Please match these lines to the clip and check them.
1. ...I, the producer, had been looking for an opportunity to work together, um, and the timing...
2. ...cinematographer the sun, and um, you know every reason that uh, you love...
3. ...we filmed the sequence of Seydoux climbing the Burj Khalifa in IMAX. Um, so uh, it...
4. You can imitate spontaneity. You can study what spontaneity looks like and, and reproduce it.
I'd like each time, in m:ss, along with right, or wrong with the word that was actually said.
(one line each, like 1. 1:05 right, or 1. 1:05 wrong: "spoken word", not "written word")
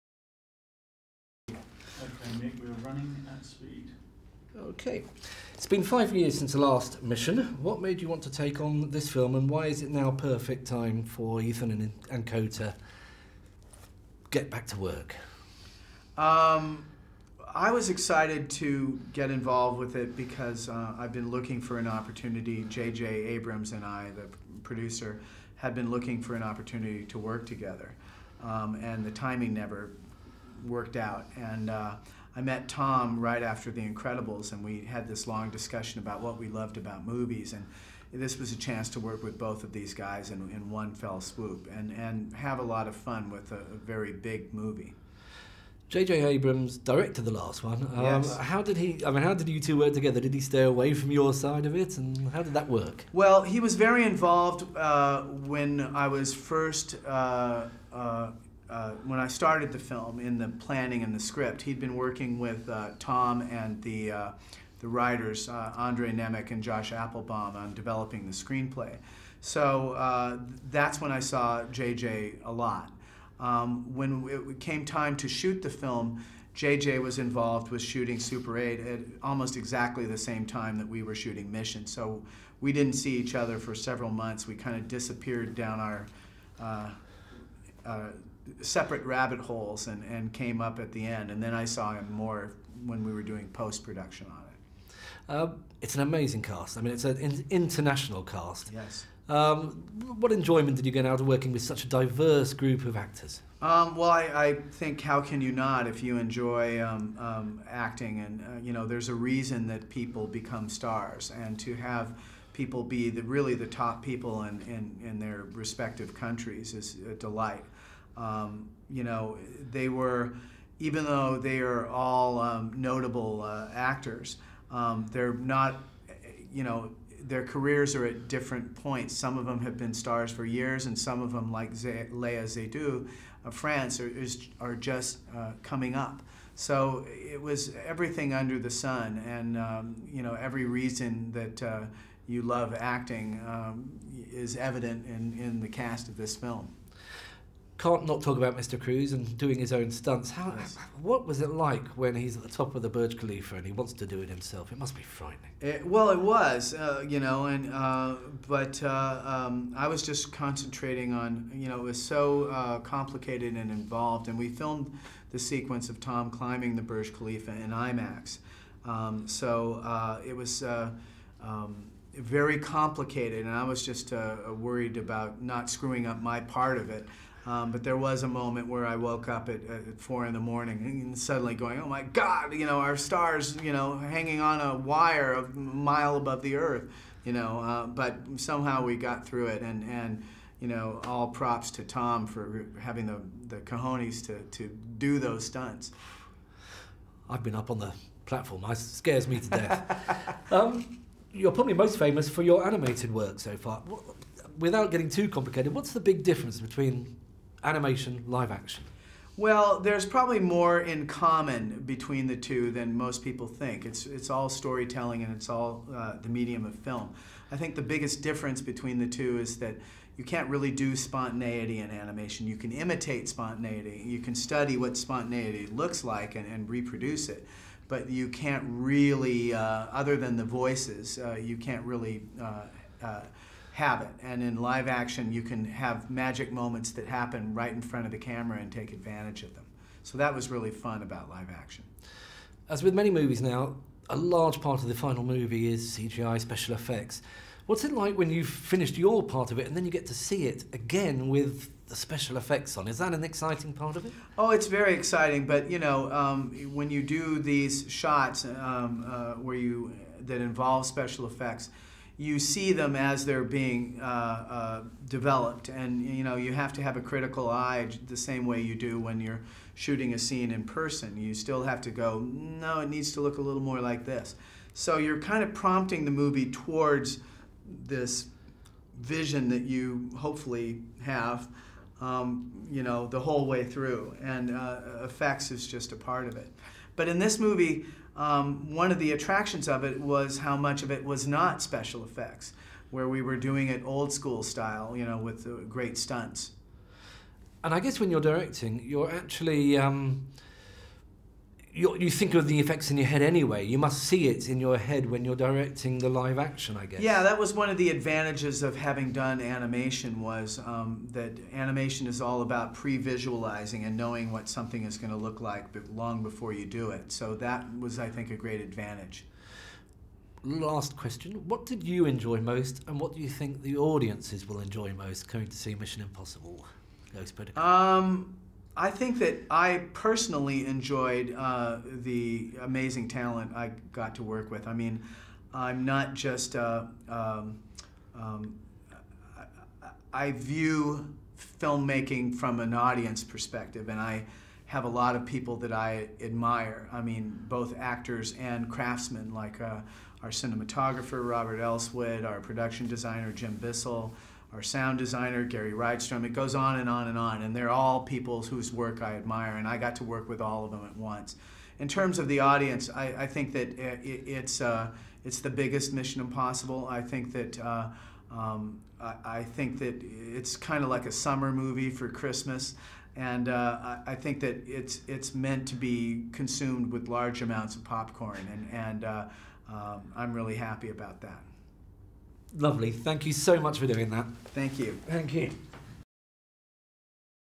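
1. 0:23 right
2. 2:18 wrong: "under", not "cinematographer"
3. 2:44 wrong: "Tom", not "Seydoux"
4. 3:42 right.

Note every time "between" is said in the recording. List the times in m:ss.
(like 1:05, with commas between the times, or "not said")
3:26, 3:31, 3:38.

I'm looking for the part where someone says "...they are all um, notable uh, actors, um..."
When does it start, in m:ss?
2:01.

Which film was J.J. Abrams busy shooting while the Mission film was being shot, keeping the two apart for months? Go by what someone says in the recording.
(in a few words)
Super 8.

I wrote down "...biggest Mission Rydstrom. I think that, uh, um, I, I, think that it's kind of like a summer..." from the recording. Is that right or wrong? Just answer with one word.
wrong.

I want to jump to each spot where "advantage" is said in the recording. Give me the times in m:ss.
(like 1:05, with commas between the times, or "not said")
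3:58, 5:07, 5:18.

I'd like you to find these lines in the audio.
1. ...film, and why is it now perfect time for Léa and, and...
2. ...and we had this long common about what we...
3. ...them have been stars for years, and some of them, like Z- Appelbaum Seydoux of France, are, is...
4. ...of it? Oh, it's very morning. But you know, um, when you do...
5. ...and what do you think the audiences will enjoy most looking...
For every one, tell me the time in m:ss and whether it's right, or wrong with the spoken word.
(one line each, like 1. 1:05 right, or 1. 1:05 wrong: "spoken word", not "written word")
1. 0:09 wrong: "Ethan", not "Léa"
2. 0:34 wrong: "discussion", not "common"
3. 2:09 wrong: "Léa", not "Appelbaum"
4. 4:13 wrong: "exciting", not "morning"
5. 5:22 wrong: "coming", not "looking".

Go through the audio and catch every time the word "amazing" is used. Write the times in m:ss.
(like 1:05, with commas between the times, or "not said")
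1:36, 5:32.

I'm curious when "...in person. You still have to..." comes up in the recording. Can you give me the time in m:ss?
4:30.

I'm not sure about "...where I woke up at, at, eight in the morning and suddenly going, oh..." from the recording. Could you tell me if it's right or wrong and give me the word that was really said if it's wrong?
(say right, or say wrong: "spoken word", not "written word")
wrong: "four", not "eight".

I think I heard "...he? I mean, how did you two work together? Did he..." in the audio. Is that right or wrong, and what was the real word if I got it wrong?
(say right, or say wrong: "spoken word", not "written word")
right.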